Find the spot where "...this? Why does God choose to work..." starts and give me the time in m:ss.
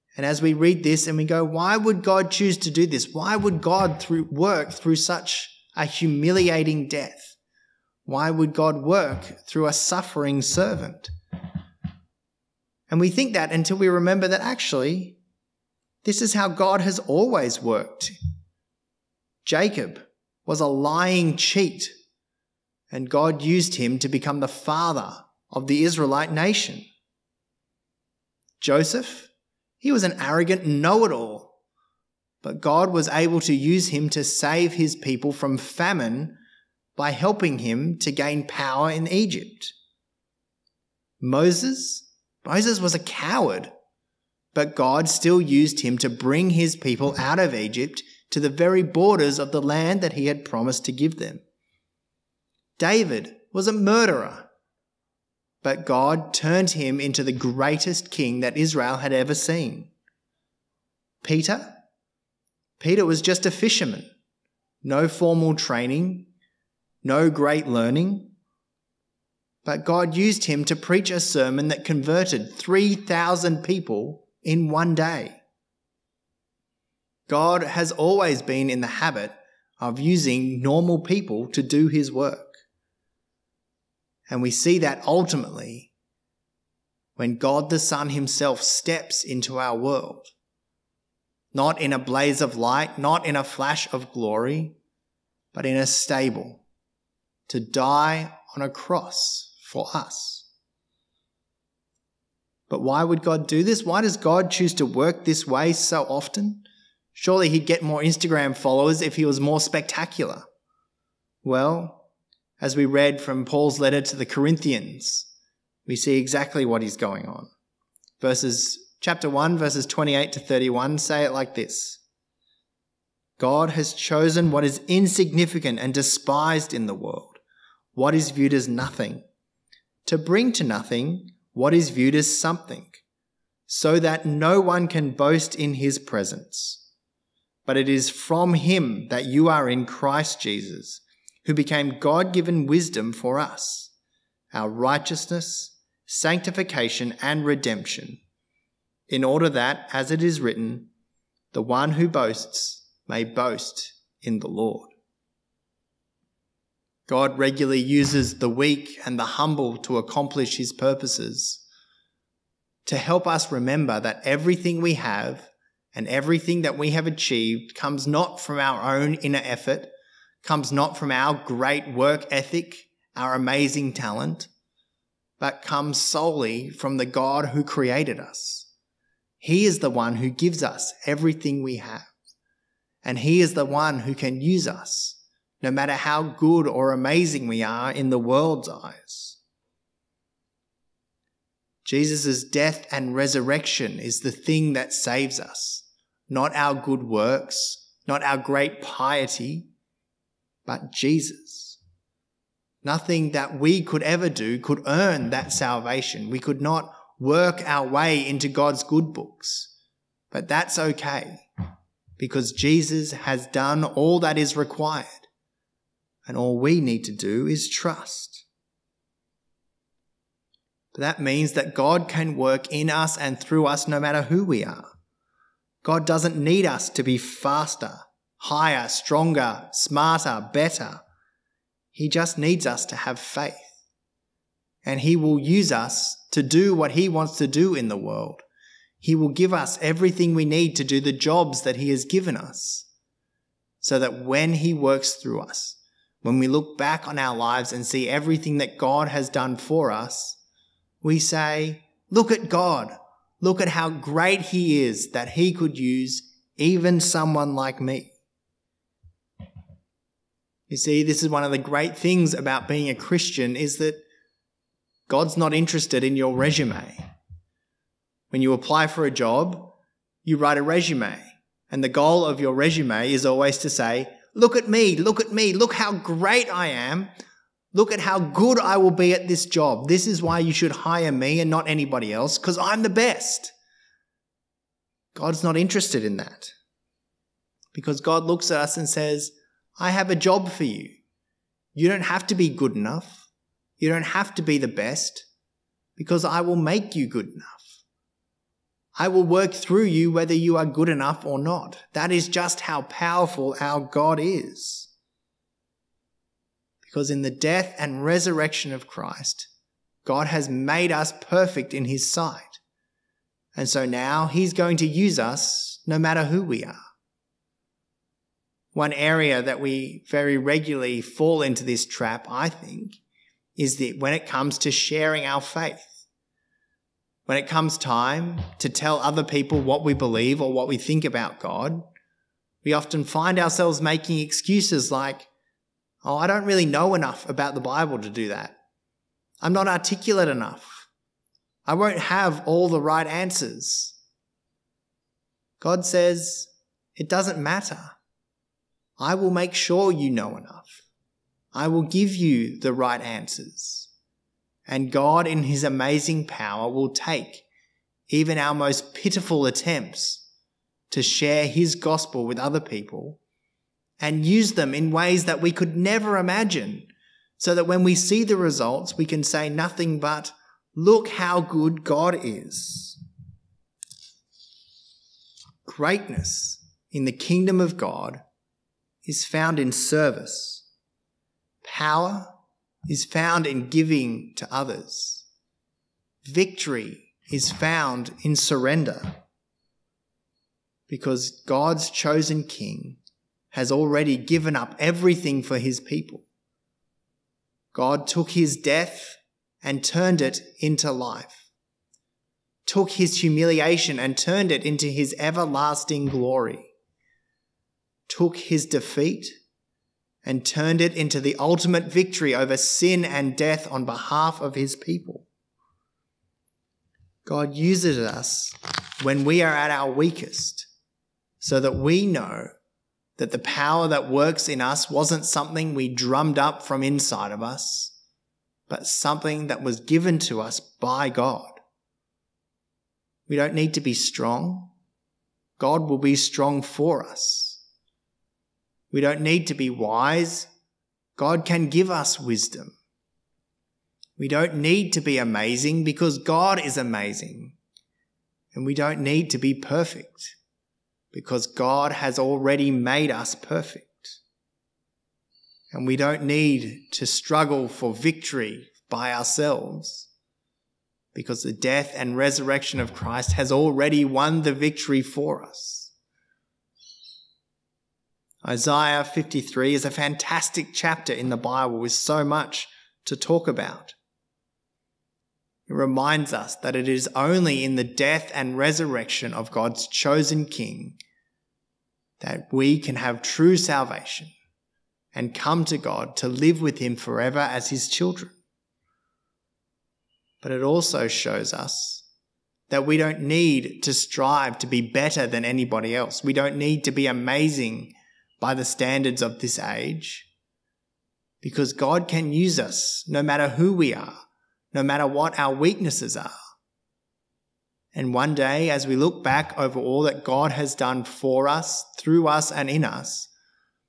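1:43.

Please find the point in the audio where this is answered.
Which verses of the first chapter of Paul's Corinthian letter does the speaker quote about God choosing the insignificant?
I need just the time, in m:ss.
1:59.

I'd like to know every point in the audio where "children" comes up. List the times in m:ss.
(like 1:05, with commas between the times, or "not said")
8:07.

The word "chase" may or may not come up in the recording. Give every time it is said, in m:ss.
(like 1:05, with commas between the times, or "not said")
not said.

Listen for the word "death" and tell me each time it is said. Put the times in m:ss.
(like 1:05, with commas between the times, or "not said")
0:06, 3:12, 5:07, 6:38, 6:53, 7:41, 7:57.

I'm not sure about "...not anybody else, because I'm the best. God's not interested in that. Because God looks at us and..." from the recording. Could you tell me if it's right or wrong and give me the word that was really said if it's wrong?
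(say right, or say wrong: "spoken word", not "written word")
right.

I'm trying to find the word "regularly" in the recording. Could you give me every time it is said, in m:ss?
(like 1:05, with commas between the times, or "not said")
2:37, 5:20.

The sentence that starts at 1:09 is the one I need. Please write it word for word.
But God used him to preach a sermon that converted 3,000 people in one day.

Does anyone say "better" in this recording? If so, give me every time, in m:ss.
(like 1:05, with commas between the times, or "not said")
3:50, 8:14.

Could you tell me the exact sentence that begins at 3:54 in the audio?
And He will use us to do what He wants to do in the world.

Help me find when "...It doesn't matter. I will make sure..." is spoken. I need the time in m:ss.
5:46.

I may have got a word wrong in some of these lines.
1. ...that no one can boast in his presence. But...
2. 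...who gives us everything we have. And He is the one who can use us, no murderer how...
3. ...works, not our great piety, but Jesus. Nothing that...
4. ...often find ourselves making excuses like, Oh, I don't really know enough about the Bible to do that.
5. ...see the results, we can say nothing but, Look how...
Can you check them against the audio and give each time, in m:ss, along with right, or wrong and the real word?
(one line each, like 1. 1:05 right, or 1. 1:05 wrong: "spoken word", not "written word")
1. 2:13 right
2. 3:00 wrong: "matter", not "murderer"
3. 3:17 right
4. 5:32 right
5. 6:07 right.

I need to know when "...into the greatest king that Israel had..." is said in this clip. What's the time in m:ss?
0:57.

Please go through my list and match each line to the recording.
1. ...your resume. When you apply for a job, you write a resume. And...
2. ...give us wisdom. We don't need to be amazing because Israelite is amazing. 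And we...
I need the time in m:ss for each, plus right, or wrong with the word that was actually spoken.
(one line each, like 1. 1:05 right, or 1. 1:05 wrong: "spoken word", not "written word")
1. 4:26 right
2. 7:21 wrong: "God", not "Israelite".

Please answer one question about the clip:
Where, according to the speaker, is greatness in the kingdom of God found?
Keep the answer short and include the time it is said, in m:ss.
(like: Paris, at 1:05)
In service, at 6:19.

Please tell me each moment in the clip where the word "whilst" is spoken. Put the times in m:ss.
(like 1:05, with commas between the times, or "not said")
not said.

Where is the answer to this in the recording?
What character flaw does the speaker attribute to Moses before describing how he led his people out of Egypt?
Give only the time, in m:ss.
0:42.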